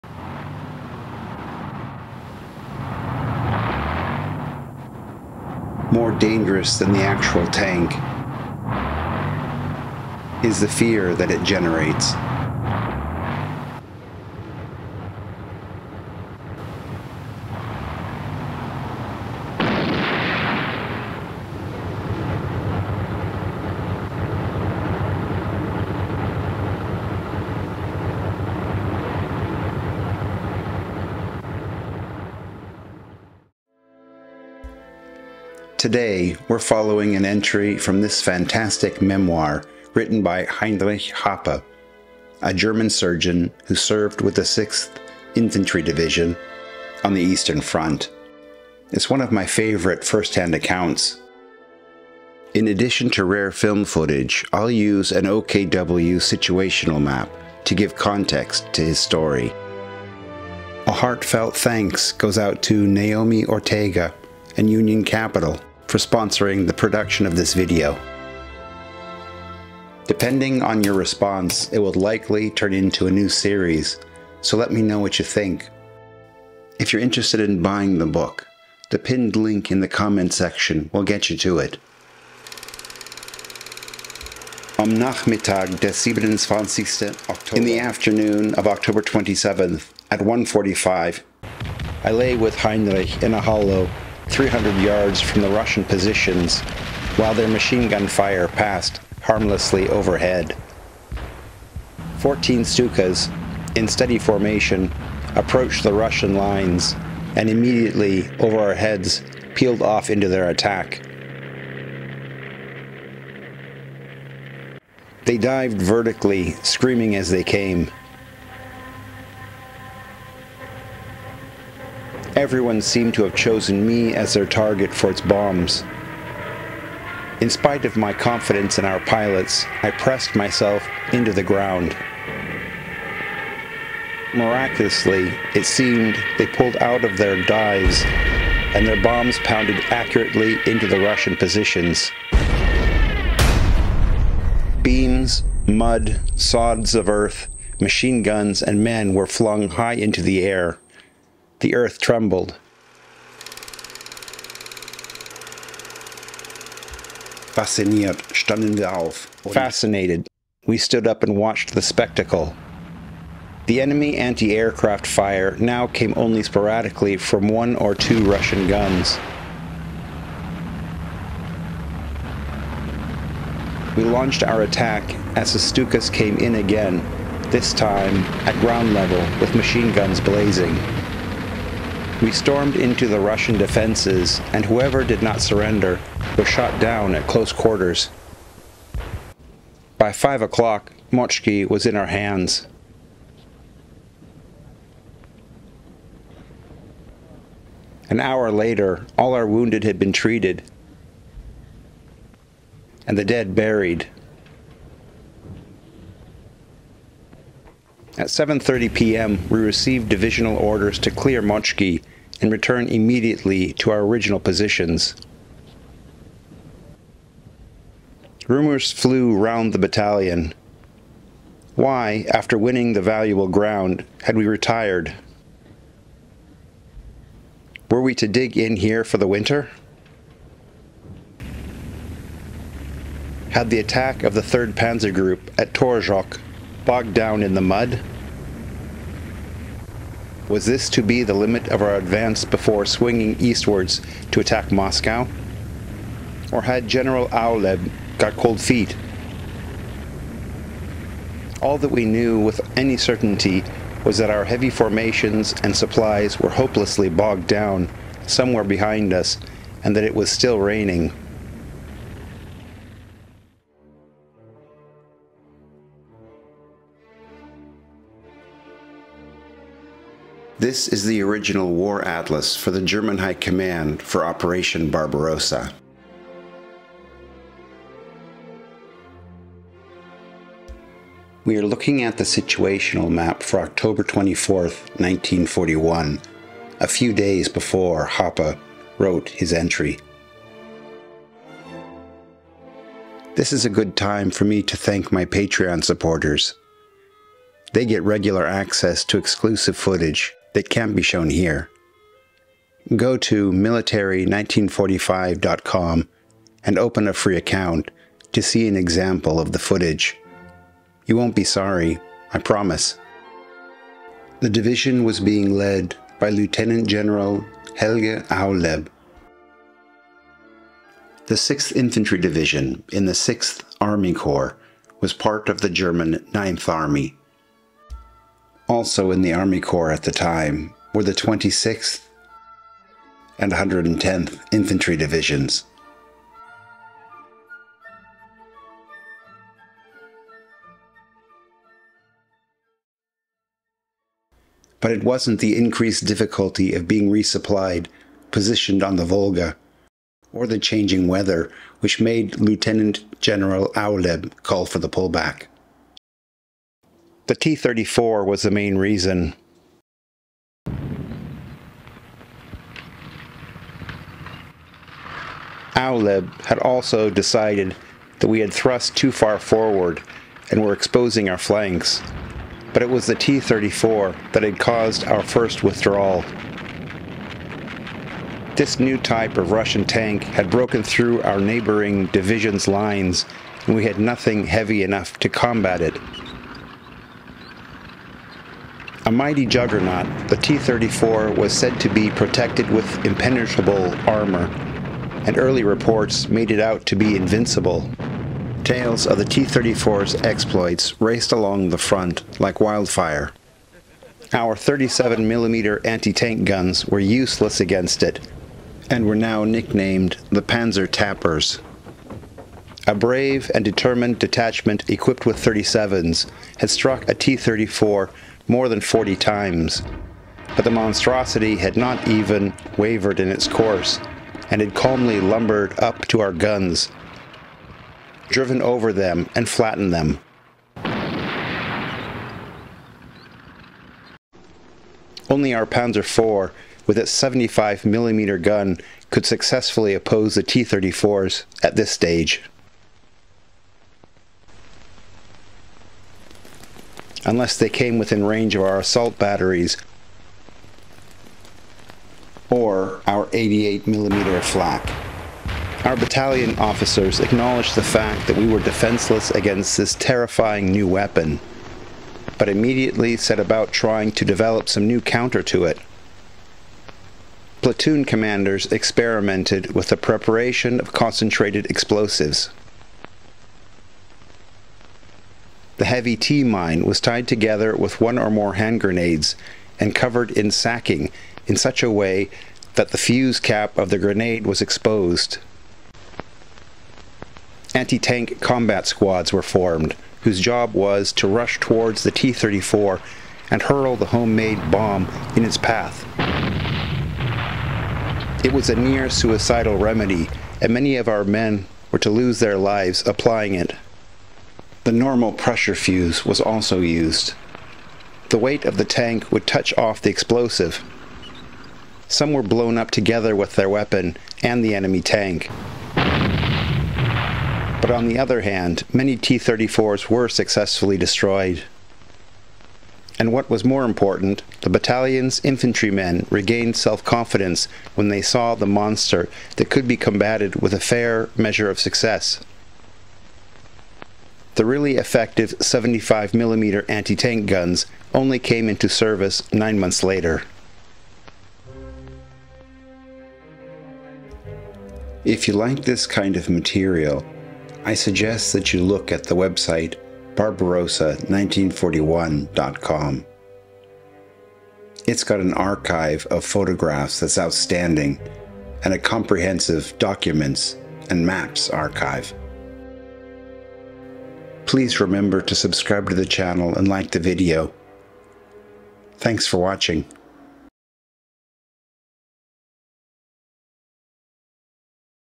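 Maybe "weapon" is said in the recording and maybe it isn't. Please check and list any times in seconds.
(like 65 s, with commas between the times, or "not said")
460 s, 513 s.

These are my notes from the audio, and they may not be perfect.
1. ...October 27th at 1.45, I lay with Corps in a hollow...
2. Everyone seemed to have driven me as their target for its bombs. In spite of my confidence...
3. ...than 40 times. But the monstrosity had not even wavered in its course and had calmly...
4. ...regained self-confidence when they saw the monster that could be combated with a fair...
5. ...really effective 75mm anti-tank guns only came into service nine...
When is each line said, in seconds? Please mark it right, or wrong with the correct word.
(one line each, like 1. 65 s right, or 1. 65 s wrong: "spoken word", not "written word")
1. 88 s wrong: "Heinrich", not "Corps"
2. 122 s wrong: "chosen", not "driven"
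3. 418 s right
4. 526 s right
5. 534 s right.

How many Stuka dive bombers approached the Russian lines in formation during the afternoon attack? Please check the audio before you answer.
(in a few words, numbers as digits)
14.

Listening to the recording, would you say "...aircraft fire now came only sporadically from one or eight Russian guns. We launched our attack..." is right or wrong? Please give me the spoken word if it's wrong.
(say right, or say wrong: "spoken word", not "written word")
wrong: "two", not "eight".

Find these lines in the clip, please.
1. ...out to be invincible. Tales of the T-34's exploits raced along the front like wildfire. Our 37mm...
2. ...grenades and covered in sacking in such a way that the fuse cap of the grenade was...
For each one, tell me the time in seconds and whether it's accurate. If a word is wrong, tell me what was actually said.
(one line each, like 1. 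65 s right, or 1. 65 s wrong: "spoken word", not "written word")
1. 396 s right
2. 478 s right.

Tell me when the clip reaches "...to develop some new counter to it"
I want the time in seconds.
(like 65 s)
464 s.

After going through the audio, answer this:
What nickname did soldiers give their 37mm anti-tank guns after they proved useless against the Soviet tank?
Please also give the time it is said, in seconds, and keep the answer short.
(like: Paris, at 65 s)
Panzer Tappers, at 410 s.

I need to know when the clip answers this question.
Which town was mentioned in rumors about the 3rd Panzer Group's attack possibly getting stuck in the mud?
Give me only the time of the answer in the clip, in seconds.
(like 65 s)
235 s.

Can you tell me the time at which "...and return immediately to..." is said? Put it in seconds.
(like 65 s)
212 s.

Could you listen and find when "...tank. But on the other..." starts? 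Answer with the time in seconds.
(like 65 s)
515 s.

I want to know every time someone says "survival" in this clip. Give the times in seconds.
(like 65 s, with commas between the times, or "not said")
not said.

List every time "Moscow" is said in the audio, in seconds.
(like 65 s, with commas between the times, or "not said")
244 s.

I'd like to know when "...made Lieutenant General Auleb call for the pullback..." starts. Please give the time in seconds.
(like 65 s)
351 s.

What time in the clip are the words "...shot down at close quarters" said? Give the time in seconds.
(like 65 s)
186 s.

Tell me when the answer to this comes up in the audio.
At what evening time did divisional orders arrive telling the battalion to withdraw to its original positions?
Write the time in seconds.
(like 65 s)
208 s.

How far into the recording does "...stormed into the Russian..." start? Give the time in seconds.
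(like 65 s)
182 s.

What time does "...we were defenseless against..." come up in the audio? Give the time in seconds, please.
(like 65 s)
458 s.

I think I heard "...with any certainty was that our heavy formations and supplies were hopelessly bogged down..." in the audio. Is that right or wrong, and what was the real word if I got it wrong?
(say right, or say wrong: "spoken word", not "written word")
right.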